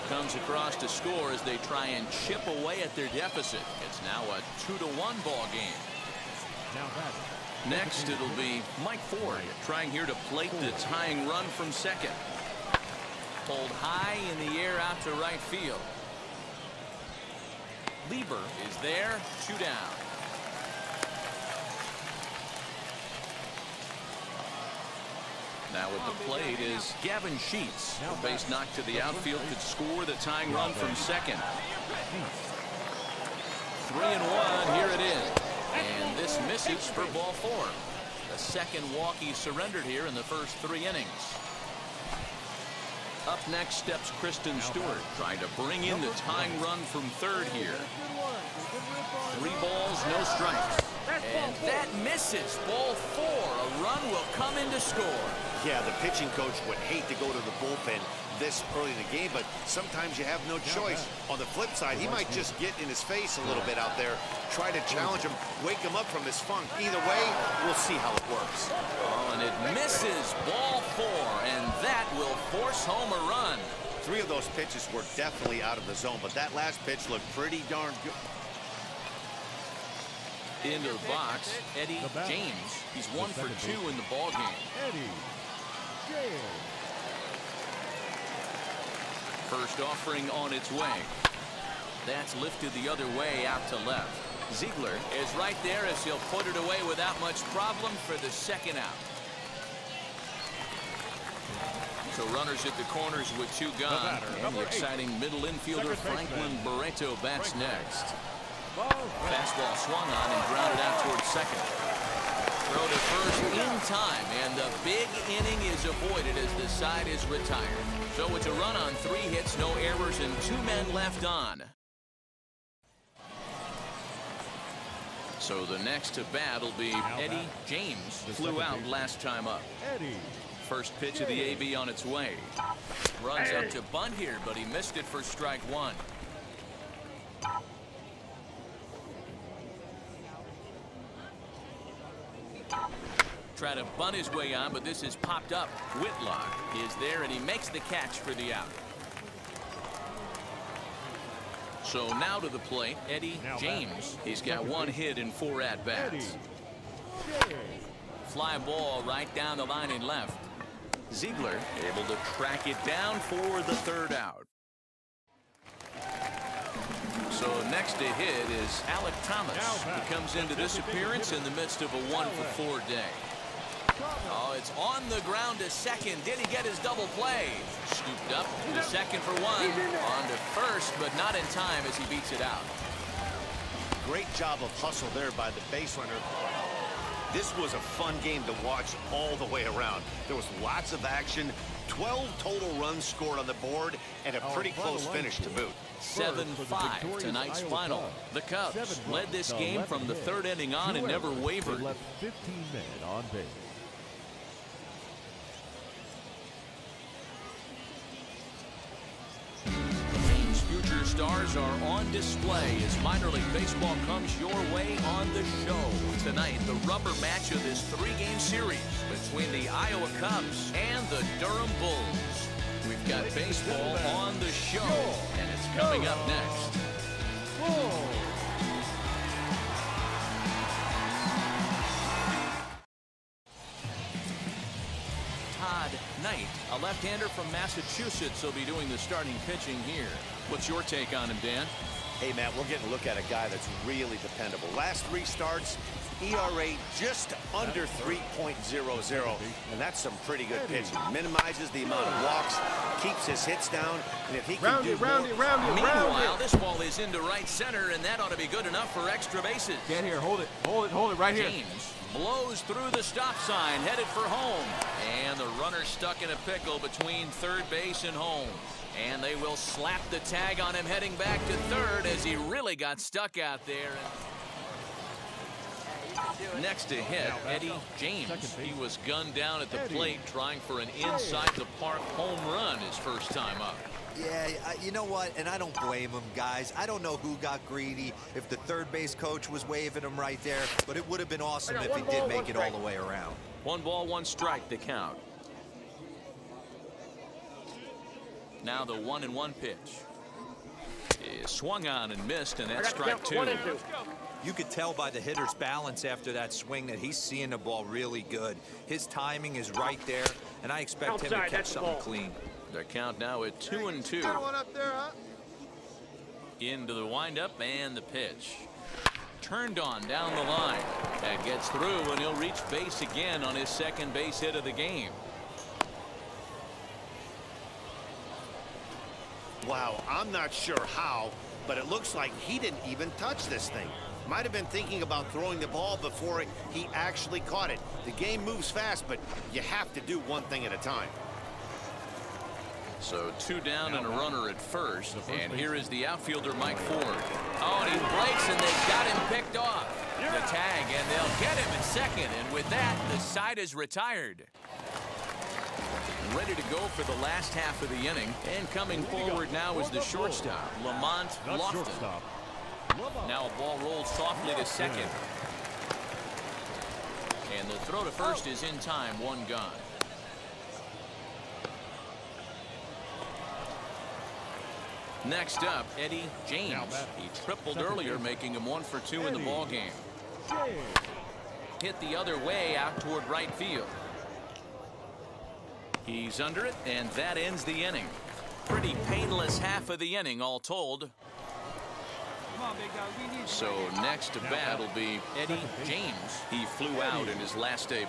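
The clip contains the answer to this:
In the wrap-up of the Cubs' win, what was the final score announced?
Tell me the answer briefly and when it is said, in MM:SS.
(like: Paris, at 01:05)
7-5, at 03:16.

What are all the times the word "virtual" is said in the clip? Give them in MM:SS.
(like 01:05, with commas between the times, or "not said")
not said.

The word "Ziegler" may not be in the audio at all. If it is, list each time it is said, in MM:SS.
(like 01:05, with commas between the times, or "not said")
01:34, 02:41.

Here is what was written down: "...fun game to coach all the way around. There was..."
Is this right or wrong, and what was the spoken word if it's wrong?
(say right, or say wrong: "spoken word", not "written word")
wrong: "watch", not "coach".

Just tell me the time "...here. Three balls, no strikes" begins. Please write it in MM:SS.
00:47.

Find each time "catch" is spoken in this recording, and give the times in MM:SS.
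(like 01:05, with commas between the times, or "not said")
02:27, 05:11.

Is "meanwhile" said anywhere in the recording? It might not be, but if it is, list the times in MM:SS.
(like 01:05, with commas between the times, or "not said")
04:15.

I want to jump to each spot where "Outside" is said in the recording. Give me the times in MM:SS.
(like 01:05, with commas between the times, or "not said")
05:11.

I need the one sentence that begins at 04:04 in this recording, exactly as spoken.
Last three starts, ERA just under 3.00, and that's some pretty good pitching.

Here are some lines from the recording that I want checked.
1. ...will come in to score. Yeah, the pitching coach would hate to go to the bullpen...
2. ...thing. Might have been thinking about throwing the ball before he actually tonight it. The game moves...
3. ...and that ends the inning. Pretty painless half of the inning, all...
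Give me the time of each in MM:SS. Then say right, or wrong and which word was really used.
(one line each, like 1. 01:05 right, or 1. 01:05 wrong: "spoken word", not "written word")
1. 00:54 right
2. 05:33 wrong: "caught", not "tonight"
3. 06:26 right.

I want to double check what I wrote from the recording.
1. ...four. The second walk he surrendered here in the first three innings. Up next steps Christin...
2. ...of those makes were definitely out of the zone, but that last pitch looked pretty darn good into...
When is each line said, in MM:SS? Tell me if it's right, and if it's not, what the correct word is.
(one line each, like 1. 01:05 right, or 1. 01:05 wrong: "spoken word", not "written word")
1. 00:37 right
2. 01:14 wrong: "pitches", not "makes".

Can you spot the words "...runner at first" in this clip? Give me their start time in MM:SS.
05:44.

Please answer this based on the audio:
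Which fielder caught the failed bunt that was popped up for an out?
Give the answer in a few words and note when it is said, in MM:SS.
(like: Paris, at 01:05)
Whitlock, at 02:26.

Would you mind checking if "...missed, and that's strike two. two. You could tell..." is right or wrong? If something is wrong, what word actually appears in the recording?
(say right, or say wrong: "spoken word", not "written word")
right.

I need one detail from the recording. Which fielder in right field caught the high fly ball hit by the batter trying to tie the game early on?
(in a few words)
Lieber.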